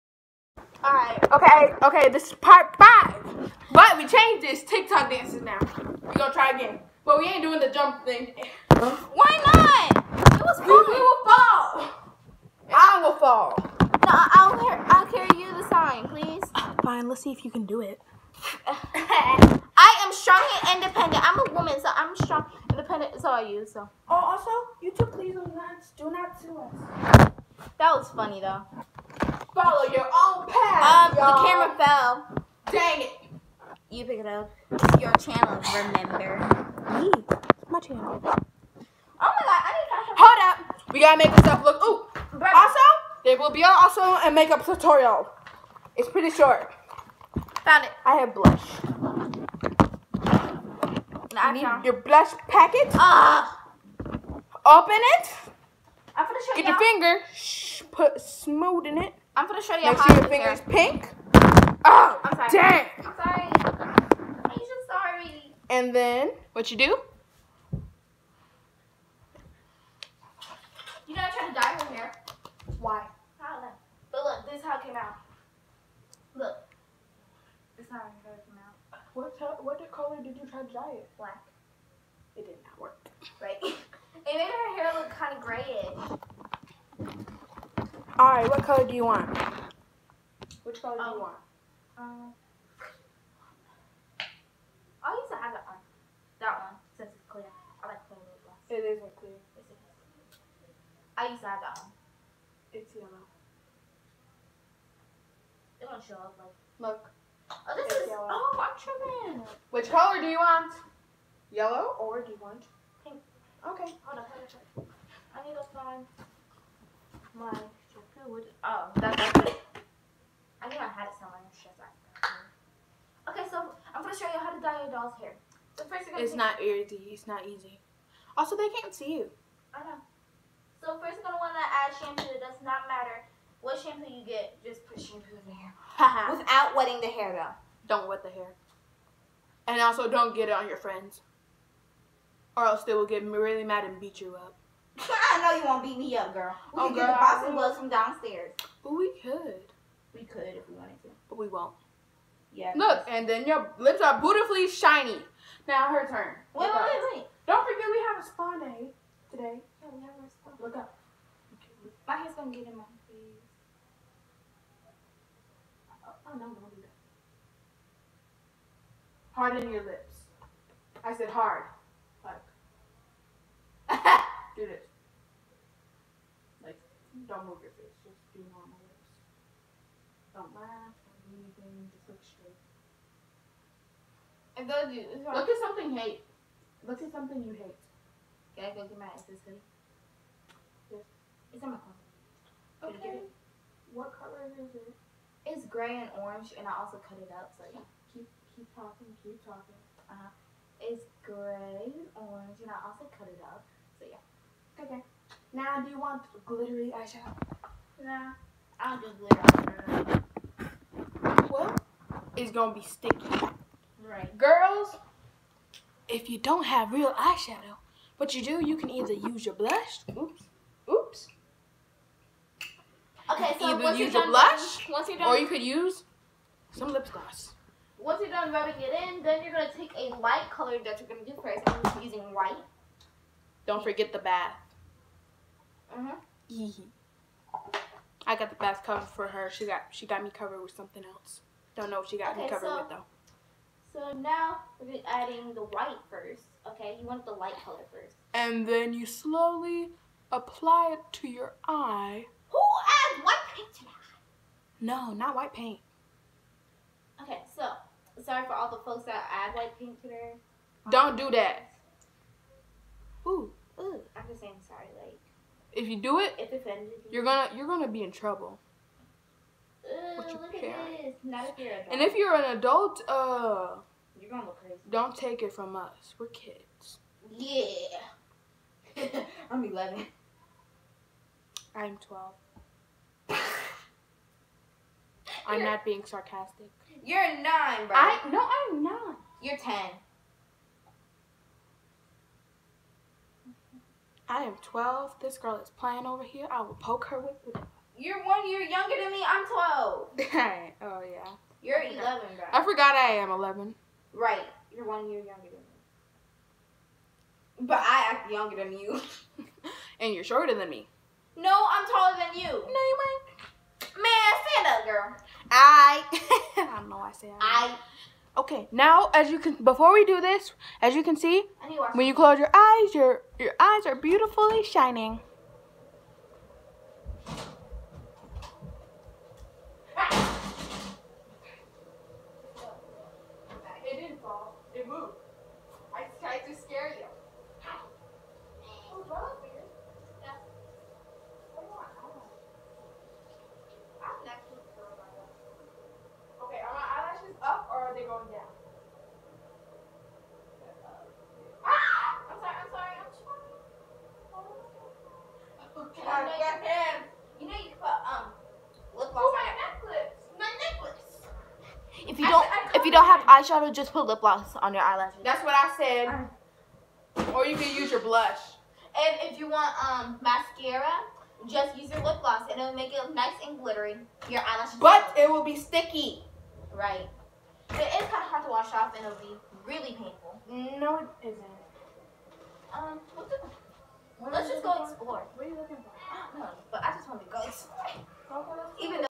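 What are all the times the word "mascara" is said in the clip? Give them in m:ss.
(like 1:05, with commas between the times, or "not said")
6:10.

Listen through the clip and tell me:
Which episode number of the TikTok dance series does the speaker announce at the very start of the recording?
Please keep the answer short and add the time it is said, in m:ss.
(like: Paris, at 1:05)
Part 5, at 0:02.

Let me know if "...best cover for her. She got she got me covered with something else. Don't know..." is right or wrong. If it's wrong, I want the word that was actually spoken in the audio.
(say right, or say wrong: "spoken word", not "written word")
right.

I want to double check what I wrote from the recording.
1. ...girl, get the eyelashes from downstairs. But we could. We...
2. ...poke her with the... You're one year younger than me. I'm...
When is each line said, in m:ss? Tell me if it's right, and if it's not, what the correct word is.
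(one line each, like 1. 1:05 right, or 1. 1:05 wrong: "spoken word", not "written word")
1. 2:26 wrong: "gloves", not "eyelashes"
2. 4:56 right.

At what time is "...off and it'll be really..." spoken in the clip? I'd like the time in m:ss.
6:18.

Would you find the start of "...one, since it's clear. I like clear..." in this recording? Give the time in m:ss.
1:36.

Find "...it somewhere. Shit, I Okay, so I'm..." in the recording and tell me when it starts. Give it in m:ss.
2:01.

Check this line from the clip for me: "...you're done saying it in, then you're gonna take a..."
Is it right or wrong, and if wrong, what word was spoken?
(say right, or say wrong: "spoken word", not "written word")
wrong: "rubbing", not "saying".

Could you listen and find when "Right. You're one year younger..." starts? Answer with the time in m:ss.
5:04.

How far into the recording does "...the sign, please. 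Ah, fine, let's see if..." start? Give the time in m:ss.
0:15.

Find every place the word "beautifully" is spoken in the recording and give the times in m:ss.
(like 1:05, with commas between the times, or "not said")
2:34, 5:23.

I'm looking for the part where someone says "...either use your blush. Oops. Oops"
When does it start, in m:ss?
3:38.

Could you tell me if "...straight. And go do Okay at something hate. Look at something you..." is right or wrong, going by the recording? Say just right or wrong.
wrong.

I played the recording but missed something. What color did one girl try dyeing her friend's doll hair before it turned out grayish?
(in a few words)
Black.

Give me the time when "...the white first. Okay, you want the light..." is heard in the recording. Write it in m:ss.
4:05.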